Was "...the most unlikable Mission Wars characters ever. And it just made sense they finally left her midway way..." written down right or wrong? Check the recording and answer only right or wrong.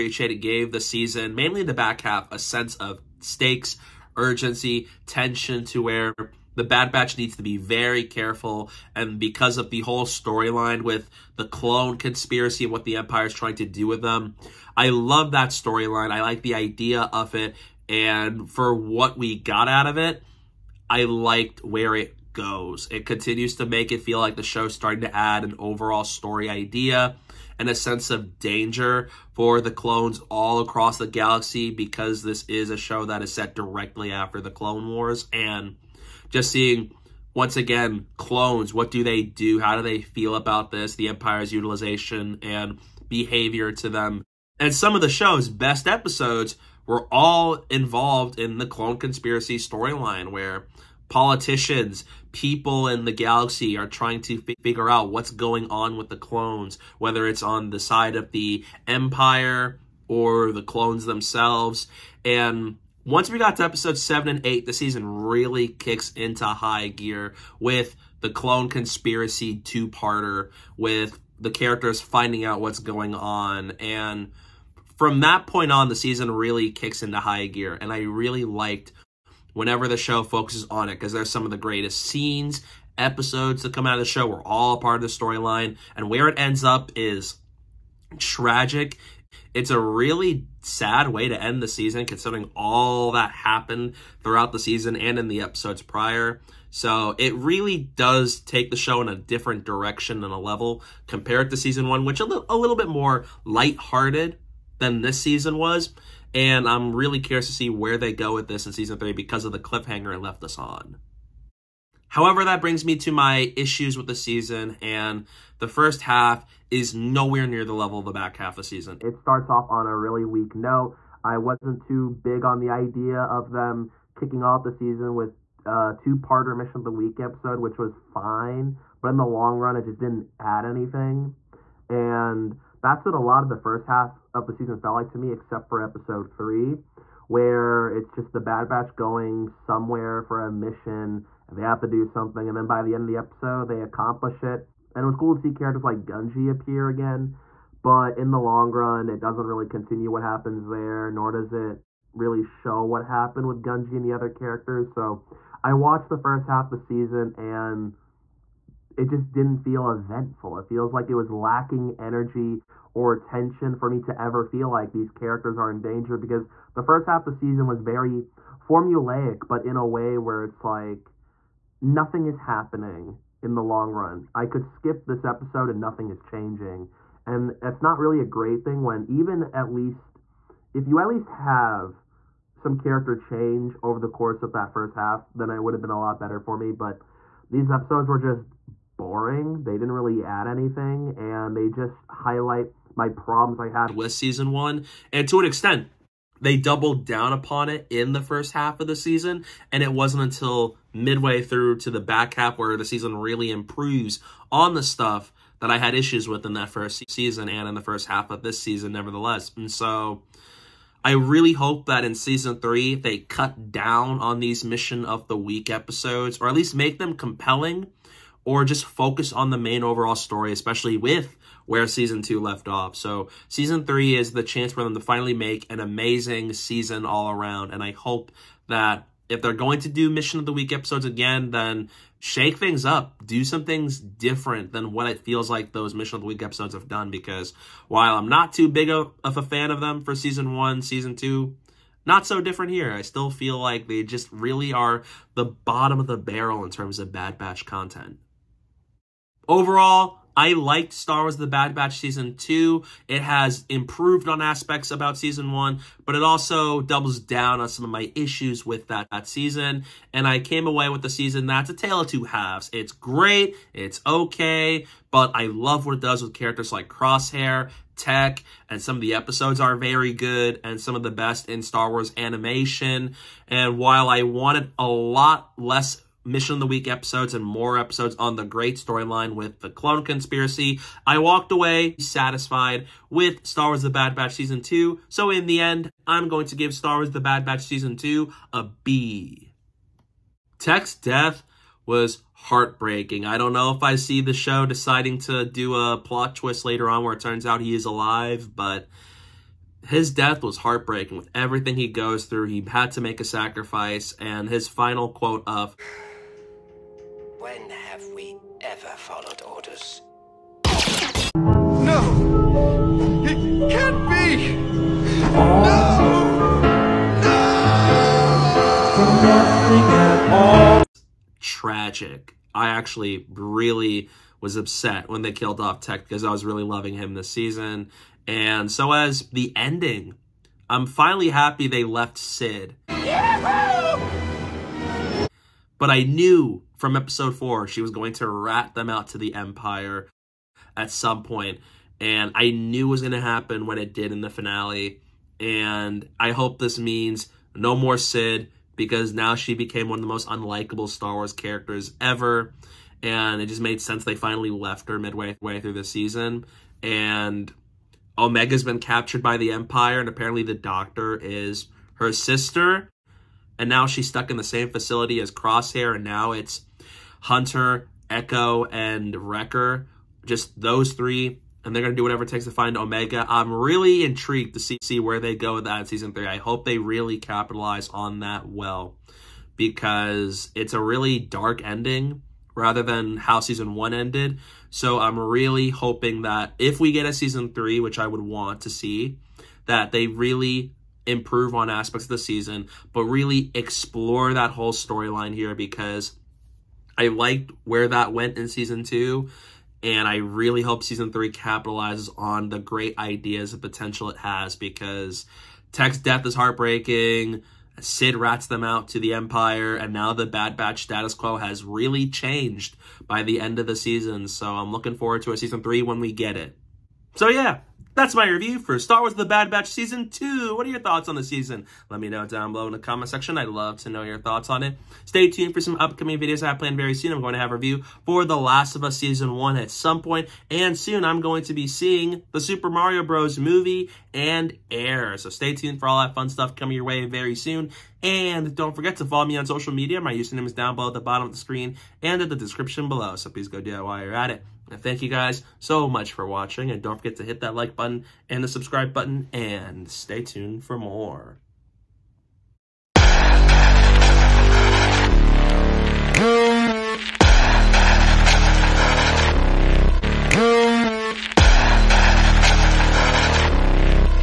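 wrong.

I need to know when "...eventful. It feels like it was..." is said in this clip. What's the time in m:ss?
2:39.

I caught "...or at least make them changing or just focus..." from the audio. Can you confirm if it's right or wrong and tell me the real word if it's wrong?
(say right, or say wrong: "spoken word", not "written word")
wrong: "compelling", not "changing".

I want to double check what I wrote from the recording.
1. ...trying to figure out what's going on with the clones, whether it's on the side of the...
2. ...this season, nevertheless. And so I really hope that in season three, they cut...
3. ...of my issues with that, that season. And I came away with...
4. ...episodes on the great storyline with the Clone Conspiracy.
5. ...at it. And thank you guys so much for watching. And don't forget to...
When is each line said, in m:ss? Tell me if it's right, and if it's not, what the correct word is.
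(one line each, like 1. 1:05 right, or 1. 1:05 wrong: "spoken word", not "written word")
1. 0:53 right
2. 3:28 right
3. 4:17 right
4. 4:37 right
5. 7:24 right.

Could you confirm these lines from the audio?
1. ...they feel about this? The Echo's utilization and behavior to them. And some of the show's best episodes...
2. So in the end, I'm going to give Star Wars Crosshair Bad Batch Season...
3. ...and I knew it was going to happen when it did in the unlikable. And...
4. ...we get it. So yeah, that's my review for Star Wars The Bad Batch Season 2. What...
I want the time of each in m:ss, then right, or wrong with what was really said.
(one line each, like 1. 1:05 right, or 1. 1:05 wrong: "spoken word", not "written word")
1. 0:39 wrong: "Empire", not "Echo"
2. 4:45 wrong: "The", not "Crosshair"
3. 5:42 wrong: "finale", not "unlikable"
4. 6:56 right.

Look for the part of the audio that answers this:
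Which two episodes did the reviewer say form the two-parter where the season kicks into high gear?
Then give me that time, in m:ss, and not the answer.
1:03.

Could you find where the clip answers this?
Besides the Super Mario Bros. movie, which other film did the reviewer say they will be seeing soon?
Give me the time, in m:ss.
7:14.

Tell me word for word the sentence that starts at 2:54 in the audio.
I could skip this episode and nothing is changing.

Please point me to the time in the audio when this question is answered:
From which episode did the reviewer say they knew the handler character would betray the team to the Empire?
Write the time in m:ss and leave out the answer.
5:36.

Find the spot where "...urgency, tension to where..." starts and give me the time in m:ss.
0:04.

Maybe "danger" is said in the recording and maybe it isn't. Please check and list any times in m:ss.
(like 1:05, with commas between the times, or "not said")
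0:28, 2:45.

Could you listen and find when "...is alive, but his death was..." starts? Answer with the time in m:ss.
4:57.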